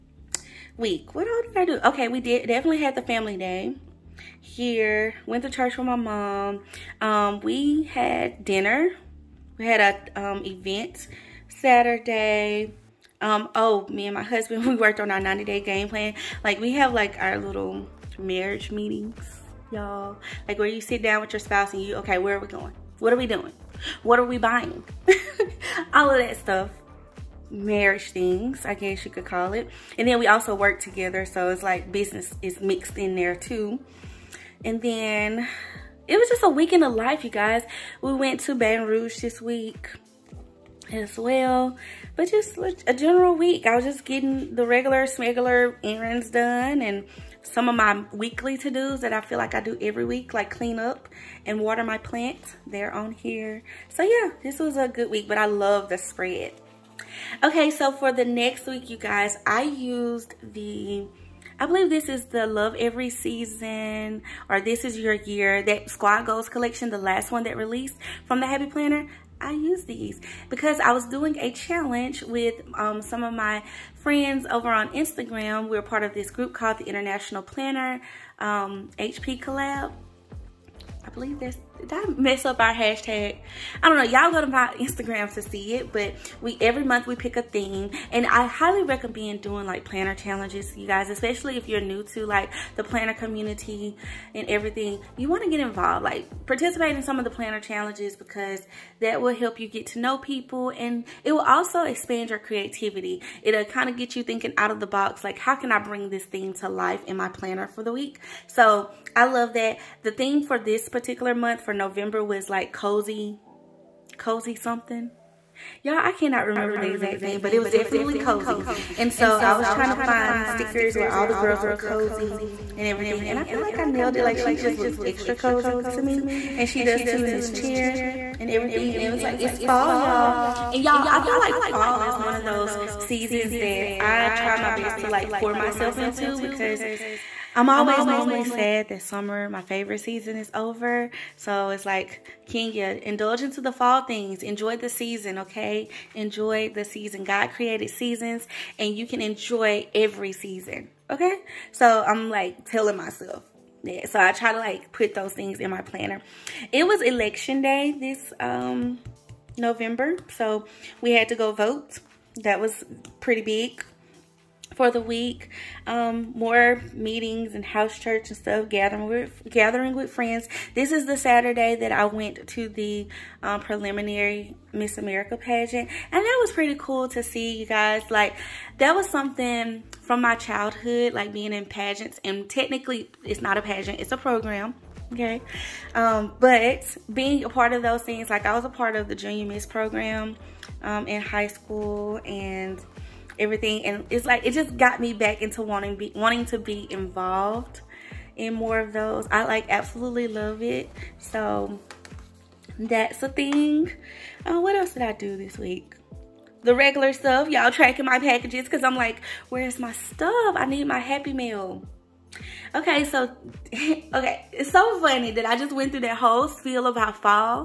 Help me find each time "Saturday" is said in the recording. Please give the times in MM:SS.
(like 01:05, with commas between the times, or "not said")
00:11, 02:51.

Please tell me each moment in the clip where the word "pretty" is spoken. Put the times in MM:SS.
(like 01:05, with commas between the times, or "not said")
02:43, 02:56.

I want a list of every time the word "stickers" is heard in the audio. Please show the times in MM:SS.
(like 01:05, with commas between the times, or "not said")
02:00.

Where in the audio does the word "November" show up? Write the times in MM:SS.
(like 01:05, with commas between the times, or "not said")
01:51, 02:39.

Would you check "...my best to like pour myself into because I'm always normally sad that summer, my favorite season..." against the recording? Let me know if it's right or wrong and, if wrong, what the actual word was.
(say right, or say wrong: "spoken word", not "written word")
right.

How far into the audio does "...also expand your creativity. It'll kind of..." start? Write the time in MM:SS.
01:41.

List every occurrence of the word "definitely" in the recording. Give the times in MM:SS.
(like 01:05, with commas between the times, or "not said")
00:02, 01:57.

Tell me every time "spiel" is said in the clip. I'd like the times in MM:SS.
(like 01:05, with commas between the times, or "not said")
03:36.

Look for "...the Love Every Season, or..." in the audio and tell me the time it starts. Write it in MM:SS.
01:02.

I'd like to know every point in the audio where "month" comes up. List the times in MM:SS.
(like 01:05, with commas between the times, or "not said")
01:26, 01:51.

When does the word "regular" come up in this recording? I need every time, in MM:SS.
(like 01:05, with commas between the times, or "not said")
00:44, 03:26.